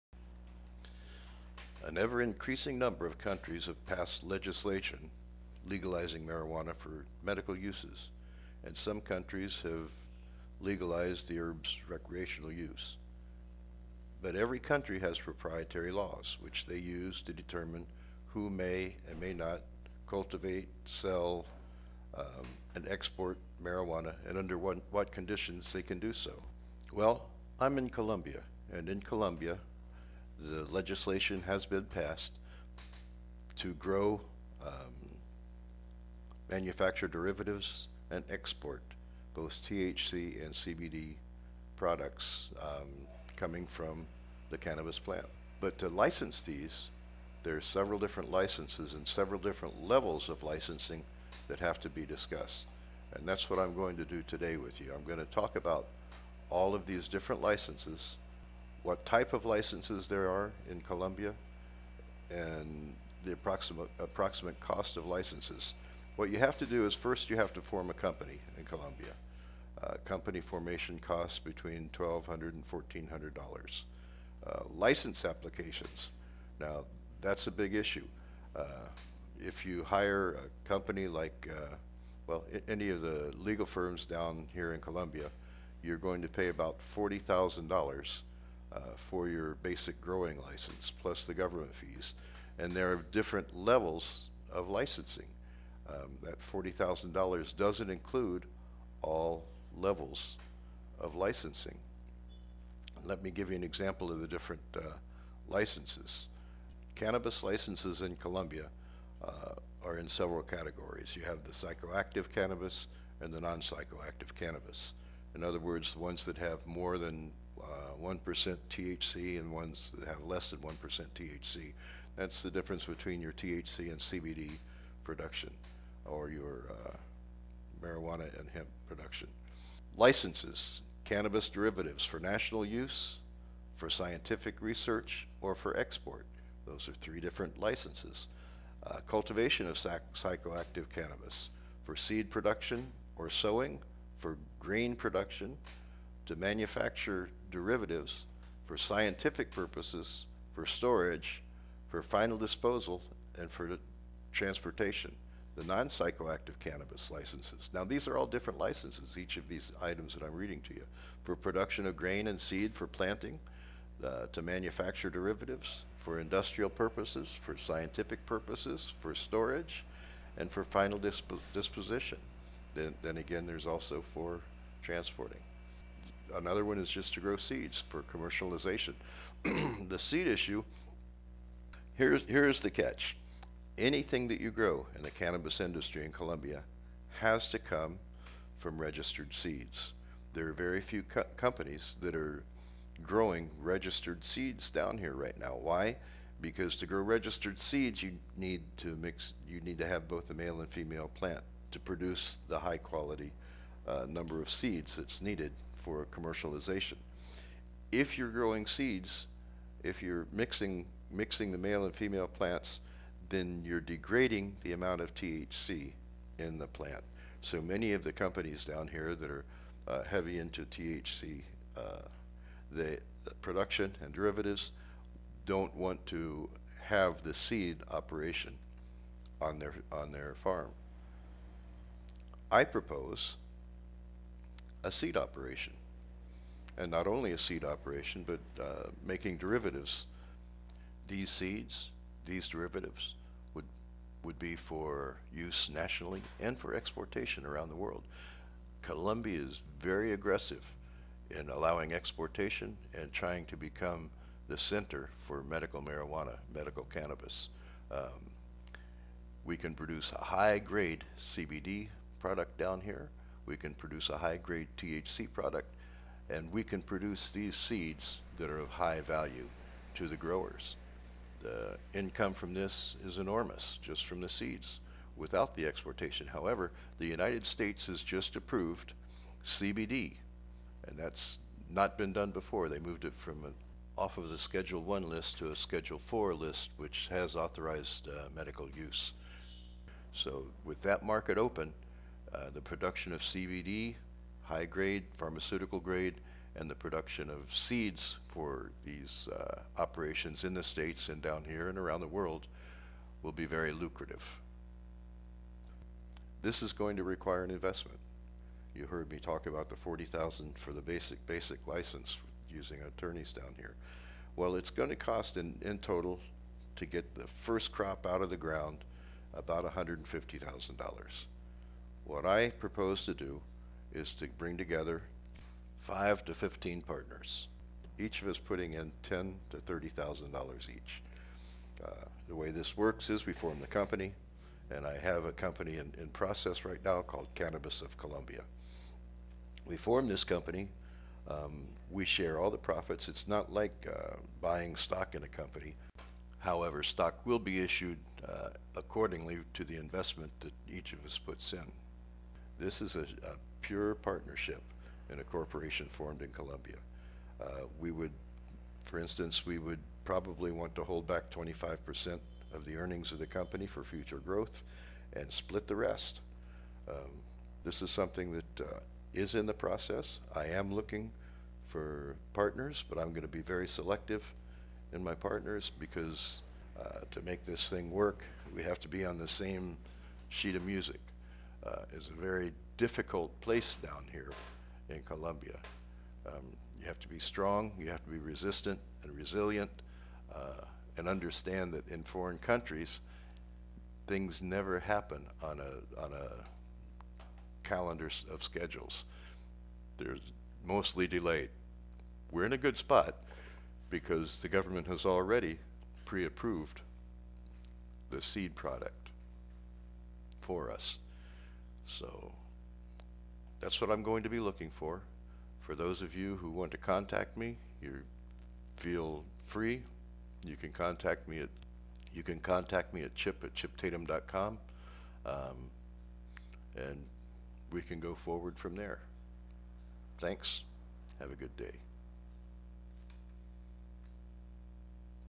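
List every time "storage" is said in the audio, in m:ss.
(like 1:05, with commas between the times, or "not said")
2:30, 2:49.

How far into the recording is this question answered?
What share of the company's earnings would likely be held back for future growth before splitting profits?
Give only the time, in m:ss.
6:01.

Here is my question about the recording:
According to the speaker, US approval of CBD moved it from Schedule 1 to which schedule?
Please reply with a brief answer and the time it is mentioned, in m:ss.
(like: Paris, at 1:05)
Schedule 4, at 4:45.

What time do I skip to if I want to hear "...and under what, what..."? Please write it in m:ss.
0:24.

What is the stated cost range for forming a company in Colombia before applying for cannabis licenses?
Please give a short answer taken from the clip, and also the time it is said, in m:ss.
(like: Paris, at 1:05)
$1,200 to $1,400, at 1:11.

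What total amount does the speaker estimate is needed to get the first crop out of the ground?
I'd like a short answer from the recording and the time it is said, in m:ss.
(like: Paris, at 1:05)
$150,000, at 5:19.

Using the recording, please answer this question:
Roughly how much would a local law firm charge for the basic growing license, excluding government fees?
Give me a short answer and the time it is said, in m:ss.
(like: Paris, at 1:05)
$40,000, at 1:26.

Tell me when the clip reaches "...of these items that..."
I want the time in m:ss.
2:39.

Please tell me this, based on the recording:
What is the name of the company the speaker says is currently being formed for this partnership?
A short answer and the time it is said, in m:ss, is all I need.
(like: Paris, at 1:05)
Cannabis of Colombia, at 5:37.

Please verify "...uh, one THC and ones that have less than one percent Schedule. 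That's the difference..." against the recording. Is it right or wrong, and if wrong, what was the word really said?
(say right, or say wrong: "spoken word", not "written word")
wrong: "THC", not "Schedule".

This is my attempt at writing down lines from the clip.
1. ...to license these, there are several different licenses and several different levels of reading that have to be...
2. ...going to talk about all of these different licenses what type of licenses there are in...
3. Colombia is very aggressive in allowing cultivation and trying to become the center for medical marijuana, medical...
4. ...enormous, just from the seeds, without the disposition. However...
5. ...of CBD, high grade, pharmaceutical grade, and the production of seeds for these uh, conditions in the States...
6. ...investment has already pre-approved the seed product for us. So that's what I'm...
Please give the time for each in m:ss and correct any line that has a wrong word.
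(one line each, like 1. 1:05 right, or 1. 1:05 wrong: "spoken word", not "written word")
1. 0:45 wrong: "licensing", not "reading"
2. 0:55 right
3. 4:08 wrong: "exportation", not "cultivation"
4. 4:33 wrong: "exportation", not "disposition"
5. 4:53 wrong: "operations", not "conditions"
6. 6:44 wrong: "government", not "investment".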